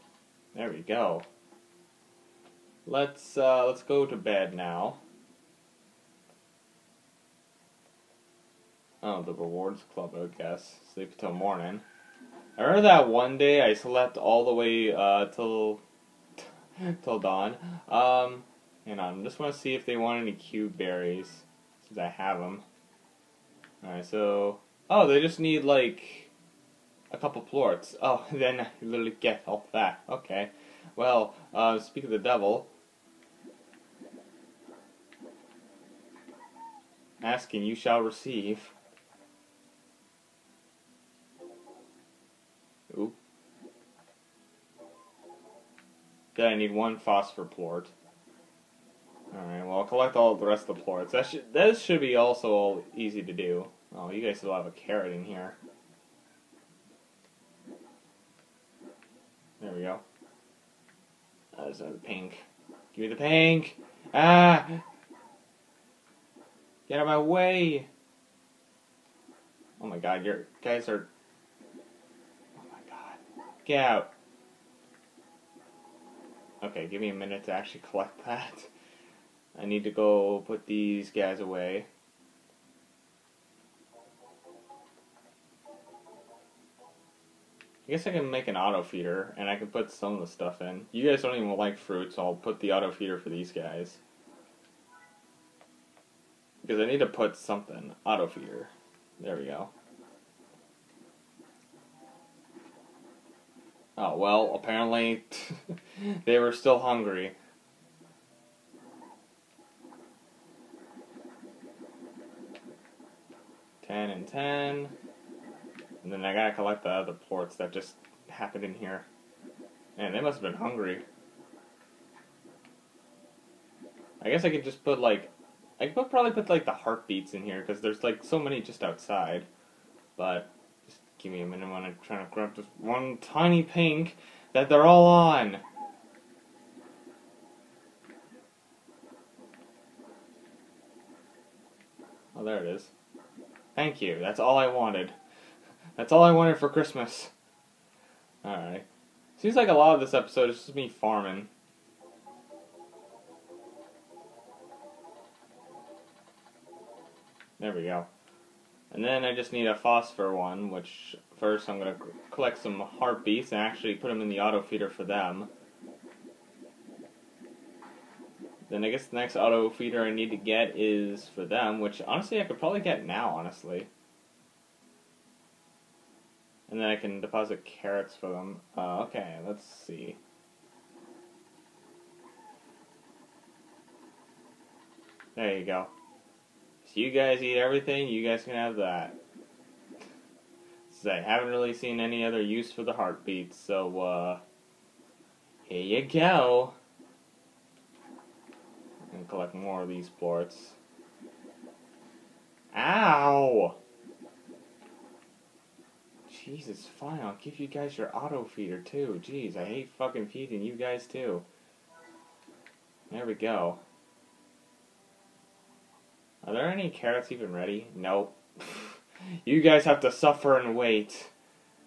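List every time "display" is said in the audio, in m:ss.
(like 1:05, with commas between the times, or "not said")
not said.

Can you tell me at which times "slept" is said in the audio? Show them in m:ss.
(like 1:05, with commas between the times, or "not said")
0:13.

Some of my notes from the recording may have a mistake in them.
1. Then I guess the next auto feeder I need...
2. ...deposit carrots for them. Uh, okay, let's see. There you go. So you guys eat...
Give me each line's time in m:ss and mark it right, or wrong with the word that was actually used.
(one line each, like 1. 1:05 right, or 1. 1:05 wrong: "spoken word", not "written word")
1. 2:48 right
2. 2:57 right.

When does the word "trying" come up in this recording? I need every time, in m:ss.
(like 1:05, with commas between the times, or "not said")
2:12.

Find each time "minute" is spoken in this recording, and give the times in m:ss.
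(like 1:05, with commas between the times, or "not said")
1:17, 2:11.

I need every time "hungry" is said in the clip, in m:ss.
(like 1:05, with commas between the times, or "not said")
1:46, 2:00.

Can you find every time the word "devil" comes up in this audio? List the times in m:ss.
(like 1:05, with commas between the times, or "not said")
0:32.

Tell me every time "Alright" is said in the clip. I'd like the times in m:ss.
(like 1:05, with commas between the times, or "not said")
0:23, 0:49, 2:28.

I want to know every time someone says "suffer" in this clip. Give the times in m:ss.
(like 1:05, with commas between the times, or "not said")
3:40.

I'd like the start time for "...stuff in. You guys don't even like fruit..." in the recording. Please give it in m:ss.
1:30.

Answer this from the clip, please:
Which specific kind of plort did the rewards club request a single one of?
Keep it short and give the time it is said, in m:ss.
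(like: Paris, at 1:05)
Phosphor plort, at 0:46.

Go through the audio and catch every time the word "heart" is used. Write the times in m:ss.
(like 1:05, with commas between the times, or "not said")
2:06, 2:42, 3:12.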